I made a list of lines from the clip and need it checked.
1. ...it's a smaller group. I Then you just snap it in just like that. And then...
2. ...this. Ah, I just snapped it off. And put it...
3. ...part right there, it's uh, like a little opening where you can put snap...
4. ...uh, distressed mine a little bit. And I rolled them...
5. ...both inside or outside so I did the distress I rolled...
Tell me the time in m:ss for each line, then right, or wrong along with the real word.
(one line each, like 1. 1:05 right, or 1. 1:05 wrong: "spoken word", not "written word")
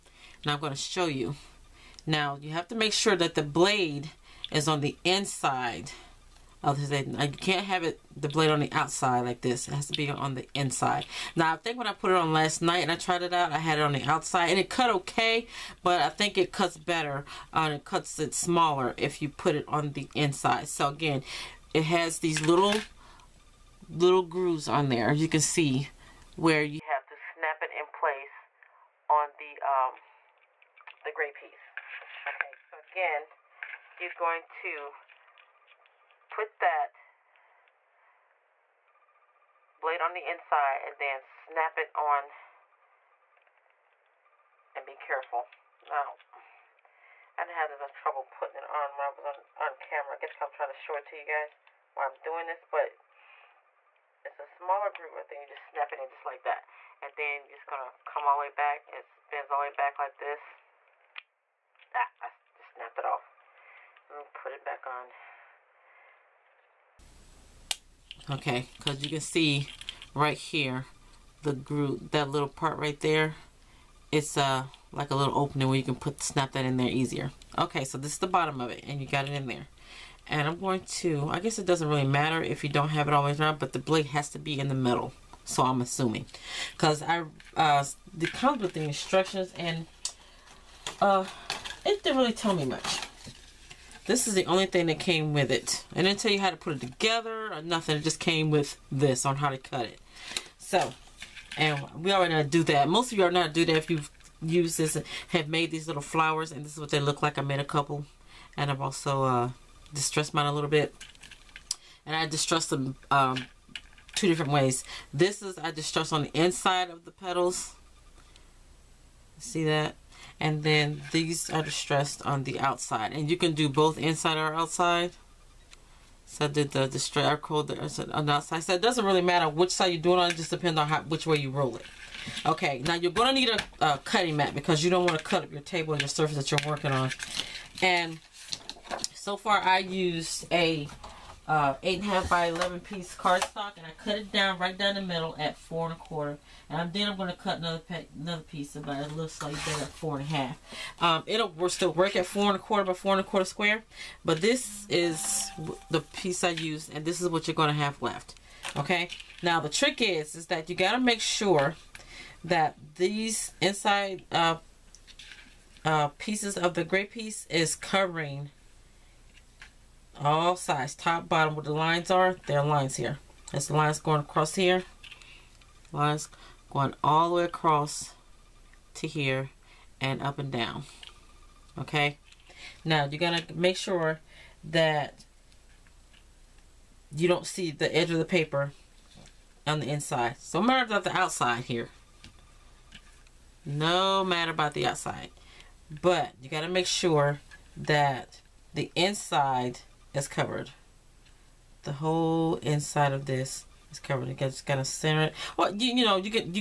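1. 0:54 right
2. 1:00 right
3. 1:12 right
4. 1:49 wrong: "distressed", not "rolled"
5. 2:03 right.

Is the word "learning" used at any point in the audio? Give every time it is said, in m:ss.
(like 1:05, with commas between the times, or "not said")
not said.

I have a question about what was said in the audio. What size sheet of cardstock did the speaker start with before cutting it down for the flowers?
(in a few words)
8 1/2 by 11.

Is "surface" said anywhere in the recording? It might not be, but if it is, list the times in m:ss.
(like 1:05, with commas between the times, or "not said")
2:16.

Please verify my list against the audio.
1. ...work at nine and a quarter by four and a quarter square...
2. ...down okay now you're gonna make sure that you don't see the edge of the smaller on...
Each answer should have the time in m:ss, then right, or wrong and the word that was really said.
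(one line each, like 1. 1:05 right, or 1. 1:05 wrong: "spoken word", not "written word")
1. 2:31 wrong: "four", not "nine"
2. 3:00 wrong: "paper", not "smaller".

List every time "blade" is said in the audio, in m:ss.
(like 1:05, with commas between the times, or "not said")
0:03, 0:08, 0:39, 1:23.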